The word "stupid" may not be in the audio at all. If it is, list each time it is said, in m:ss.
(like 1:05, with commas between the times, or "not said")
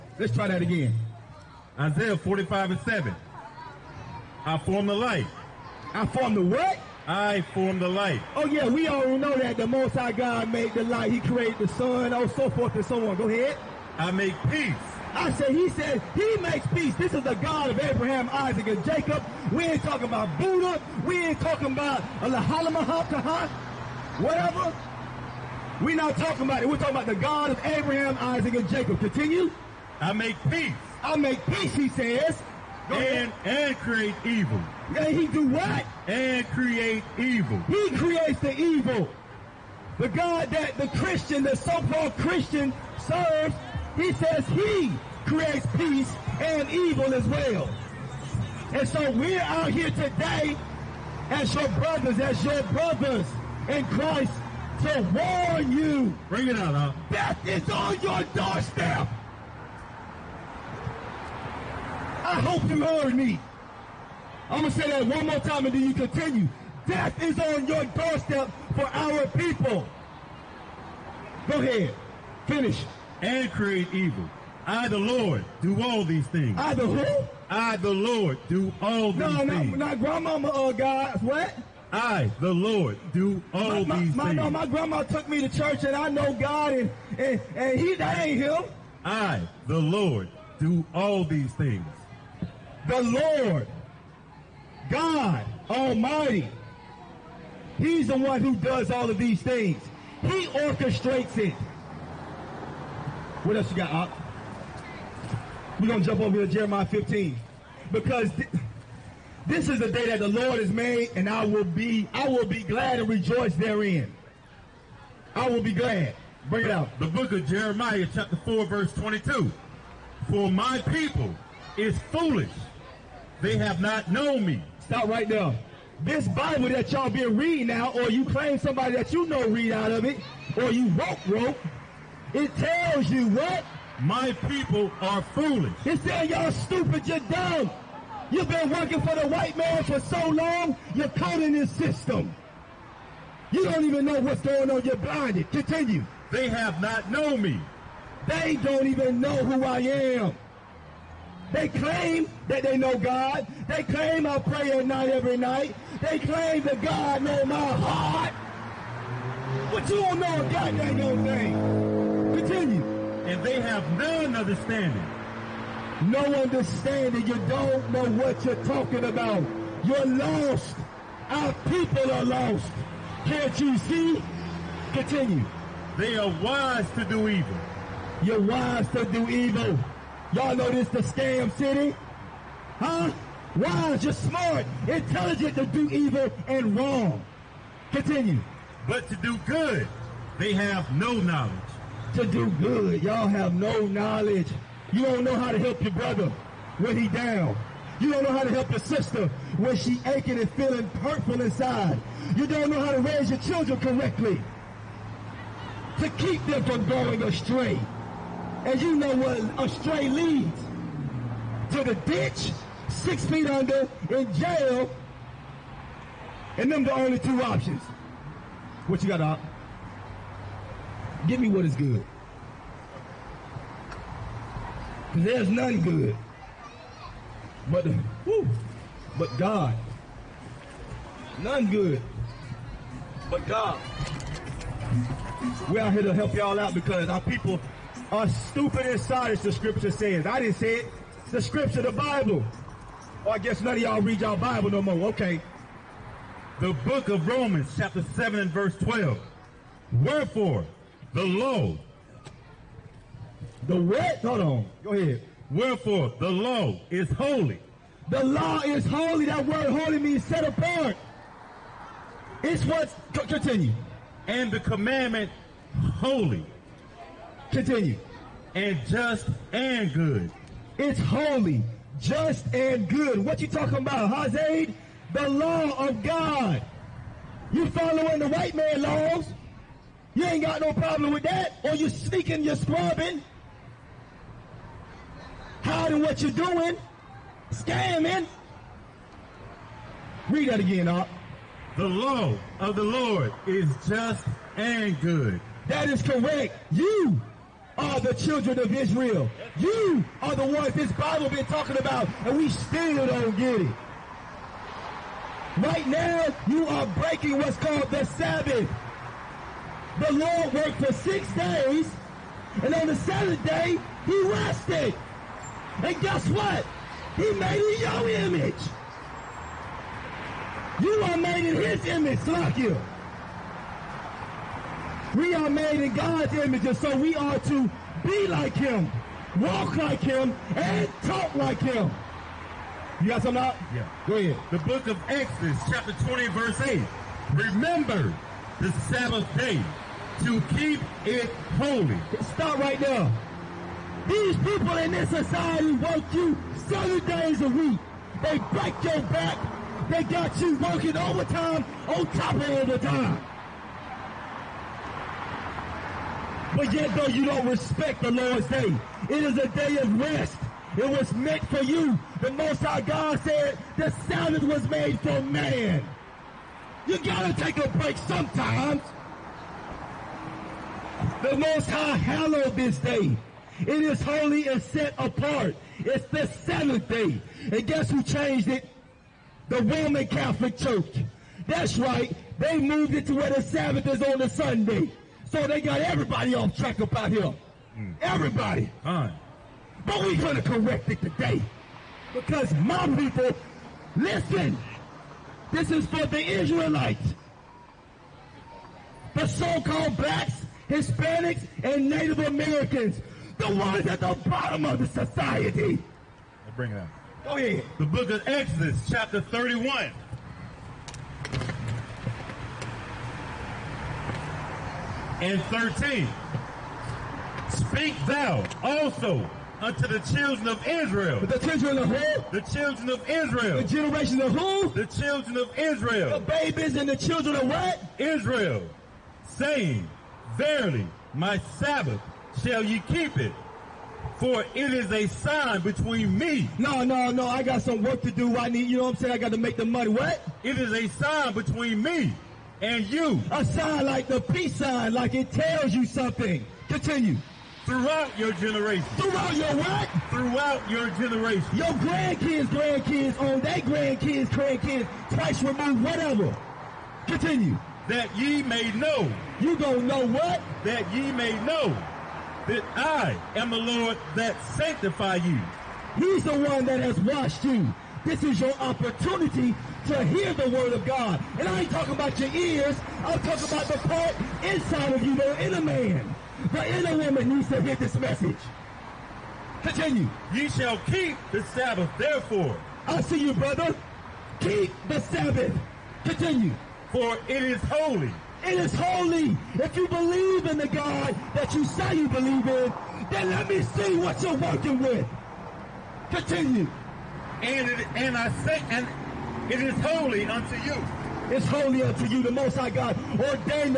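2:16, 3:58.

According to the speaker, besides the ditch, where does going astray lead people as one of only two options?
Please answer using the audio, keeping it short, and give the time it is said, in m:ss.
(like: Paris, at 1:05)
Jail, at 3:34.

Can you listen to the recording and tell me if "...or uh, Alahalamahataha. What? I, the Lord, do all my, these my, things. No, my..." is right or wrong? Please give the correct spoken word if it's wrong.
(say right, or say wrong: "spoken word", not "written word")
wrong: "God", not "Alahalamahataha".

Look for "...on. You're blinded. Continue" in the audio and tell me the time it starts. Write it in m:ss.
2:24.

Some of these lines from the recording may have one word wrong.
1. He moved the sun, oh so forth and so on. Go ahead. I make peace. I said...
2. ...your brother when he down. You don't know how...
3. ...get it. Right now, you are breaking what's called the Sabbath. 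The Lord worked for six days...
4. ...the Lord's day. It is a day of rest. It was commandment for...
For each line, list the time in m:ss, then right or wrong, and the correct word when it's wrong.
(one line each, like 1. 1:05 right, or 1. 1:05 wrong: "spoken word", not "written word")
1. 0:11 wrong: "created", not "moved"
2. 3:15 right
3. 5:03 right
4. 5:58 wrong: "meant", not "commandment".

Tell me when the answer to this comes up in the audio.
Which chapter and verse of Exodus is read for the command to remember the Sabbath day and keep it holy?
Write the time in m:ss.
5:35.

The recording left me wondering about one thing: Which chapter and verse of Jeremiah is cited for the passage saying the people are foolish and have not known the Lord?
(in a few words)
Chapter 4, verse 22.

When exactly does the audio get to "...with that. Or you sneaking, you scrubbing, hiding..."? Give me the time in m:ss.
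4:41.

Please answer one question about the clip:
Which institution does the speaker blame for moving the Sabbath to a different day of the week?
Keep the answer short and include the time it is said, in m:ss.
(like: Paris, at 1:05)
The Roman Catholic Church, at 6:19.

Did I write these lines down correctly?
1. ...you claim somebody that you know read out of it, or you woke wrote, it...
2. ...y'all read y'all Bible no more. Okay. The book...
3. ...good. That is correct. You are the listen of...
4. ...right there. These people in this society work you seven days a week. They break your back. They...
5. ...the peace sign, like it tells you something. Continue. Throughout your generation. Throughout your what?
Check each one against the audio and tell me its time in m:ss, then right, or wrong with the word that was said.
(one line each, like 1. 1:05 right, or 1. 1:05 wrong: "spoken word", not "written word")
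1. 2:08 right
2. 4:03 right
3. 4:55 wrong: "children", not "listen"
4. 5:42 right
5. 7:24 right.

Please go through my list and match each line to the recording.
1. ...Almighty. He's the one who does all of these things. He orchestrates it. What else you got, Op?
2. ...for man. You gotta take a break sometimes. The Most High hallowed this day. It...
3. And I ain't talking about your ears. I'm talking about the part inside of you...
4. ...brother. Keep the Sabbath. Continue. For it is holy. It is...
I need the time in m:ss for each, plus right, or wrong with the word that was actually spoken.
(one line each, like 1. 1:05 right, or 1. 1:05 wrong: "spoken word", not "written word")
1. 1:35 right
2. 6:04 right
3. 7:51 right
4. 8:03 right.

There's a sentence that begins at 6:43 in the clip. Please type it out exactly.
The ones at the bottom of the society.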